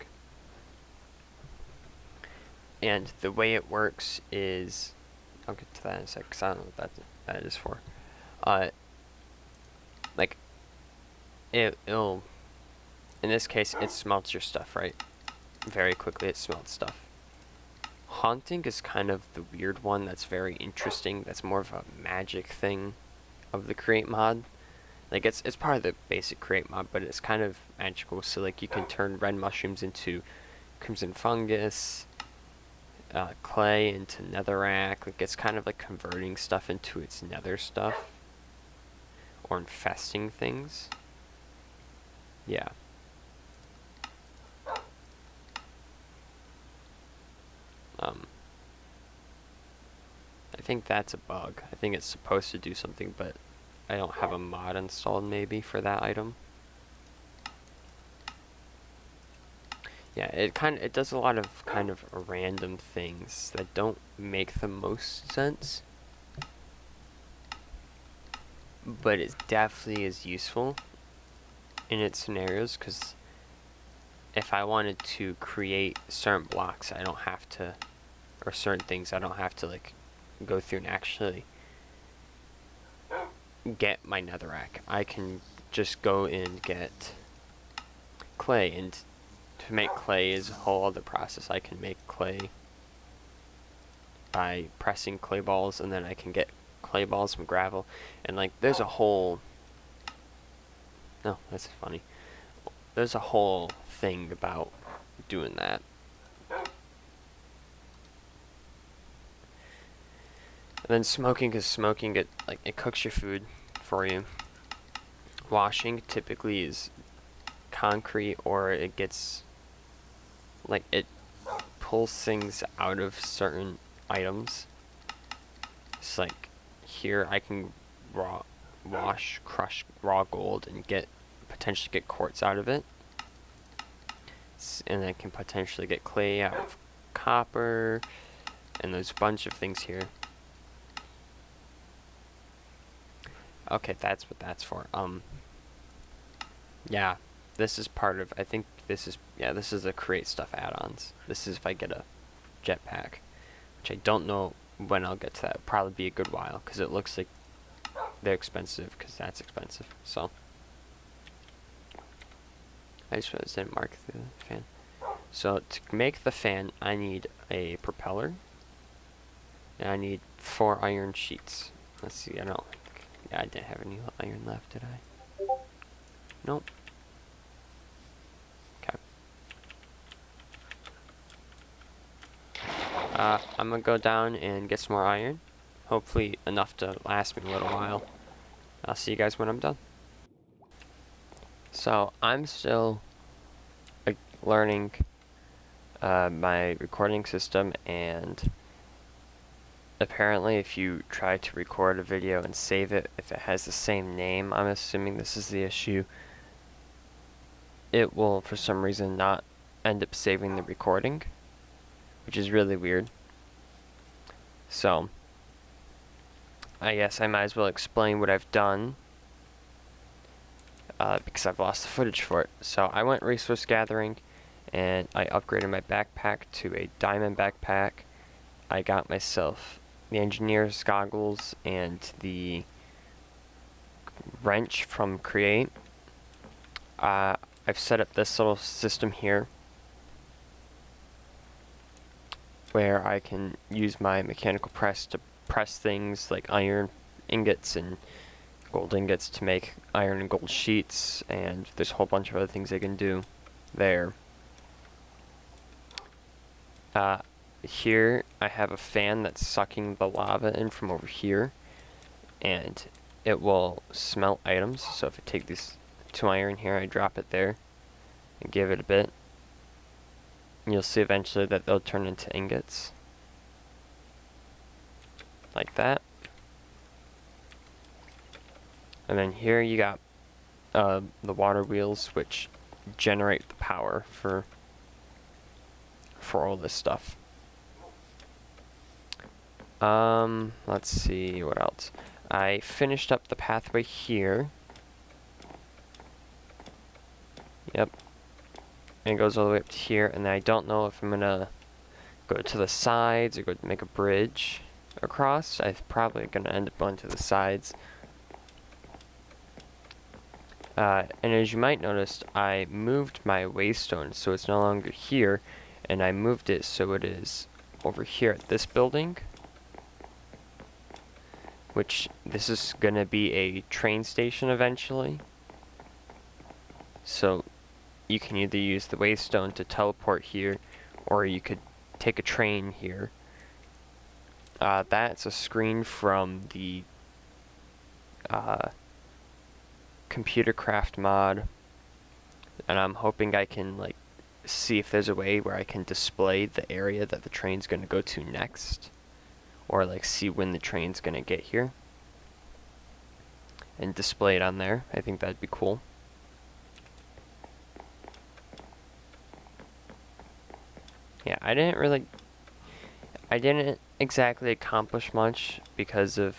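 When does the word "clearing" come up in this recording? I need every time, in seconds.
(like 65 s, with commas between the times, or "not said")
not said.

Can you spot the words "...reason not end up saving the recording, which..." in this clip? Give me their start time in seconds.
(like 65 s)
208 s.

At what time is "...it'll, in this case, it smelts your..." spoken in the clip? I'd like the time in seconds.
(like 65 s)
11 s.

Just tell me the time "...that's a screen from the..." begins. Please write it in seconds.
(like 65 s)
334 s.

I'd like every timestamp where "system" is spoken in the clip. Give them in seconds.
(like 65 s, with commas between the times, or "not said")
197 s, 238 s.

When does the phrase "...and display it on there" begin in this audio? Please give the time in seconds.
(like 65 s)
353 s.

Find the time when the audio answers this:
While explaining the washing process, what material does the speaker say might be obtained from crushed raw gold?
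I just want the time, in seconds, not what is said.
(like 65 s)
132 s.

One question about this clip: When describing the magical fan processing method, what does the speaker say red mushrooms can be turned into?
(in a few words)
Crimson fungus.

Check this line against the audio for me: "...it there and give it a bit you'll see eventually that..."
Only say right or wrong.
right.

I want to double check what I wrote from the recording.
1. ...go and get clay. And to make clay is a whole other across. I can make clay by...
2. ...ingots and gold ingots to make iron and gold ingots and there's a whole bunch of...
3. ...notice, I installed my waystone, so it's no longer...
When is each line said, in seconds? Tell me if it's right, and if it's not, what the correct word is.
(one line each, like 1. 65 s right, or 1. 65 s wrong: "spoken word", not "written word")
1. 86 s wrong: "process", not "across"
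2. 247 s wrong: "sheets", not "ingots"
3. 311 s wrong: "moved", not "installed".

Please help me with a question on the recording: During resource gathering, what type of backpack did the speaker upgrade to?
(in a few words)
Diamond backpack.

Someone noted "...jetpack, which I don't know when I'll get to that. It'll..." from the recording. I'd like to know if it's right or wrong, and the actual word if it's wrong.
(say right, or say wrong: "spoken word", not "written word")
right.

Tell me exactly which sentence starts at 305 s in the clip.
I'm probably gonna end up going to the sides.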